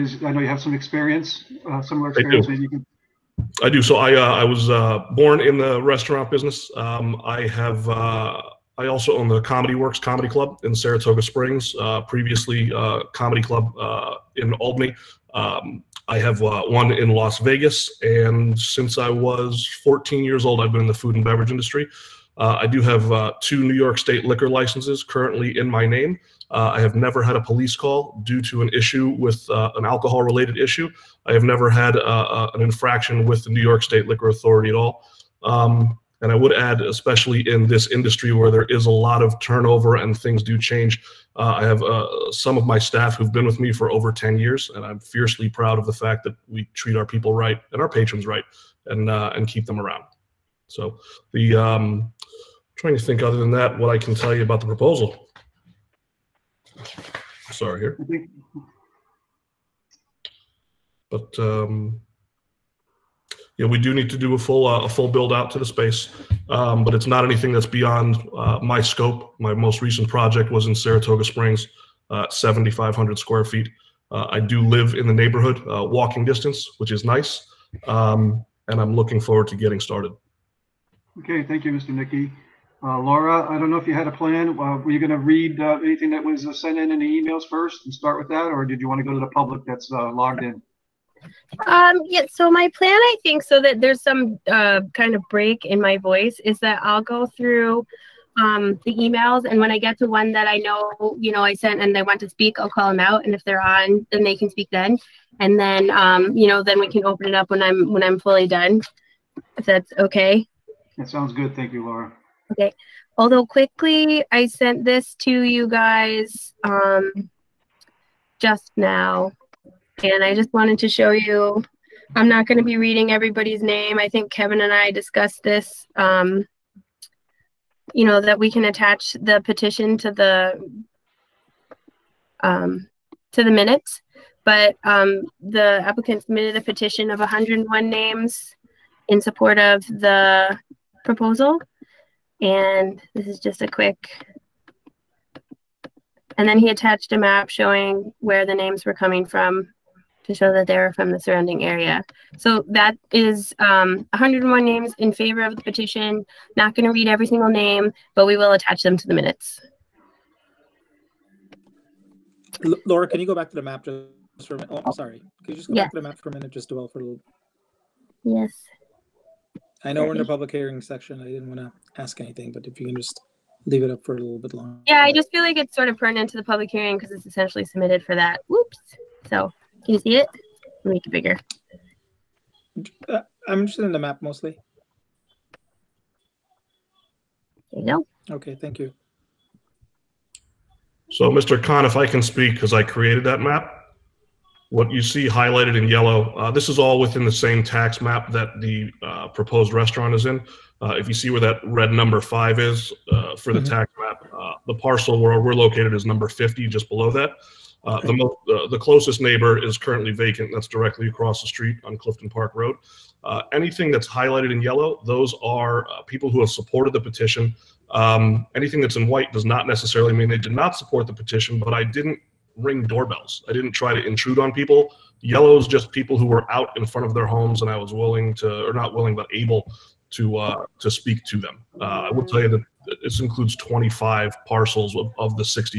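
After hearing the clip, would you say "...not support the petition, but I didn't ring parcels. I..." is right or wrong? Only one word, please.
wrong.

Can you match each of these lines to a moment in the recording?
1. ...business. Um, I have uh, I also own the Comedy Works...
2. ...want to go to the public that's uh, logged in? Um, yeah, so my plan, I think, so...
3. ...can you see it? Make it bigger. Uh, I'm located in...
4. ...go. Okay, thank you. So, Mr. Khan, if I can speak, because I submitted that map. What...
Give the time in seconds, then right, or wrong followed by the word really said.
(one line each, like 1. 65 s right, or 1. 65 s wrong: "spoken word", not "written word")
1. 6 s right
2. 88 s right
3. 179 s wrong: "interested", not "located"
4. 188 s wrong: "created", not "submitted".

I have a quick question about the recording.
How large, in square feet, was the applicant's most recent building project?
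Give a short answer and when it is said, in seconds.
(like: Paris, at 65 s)
7,500, at 72 s.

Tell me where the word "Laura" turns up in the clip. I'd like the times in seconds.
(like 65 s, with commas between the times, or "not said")
82 s, 111 s, 162 s.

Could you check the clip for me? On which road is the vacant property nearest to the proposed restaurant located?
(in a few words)
Clifton Park Road.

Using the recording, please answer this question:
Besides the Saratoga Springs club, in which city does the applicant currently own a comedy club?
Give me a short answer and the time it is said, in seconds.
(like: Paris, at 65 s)
Las Vegas, at 17 s.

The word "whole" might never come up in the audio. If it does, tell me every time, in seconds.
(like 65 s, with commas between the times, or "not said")
not said.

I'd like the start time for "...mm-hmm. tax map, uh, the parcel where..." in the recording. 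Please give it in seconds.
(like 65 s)
203 s.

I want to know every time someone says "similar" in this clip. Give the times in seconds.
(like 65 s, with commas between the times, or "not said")
1 s.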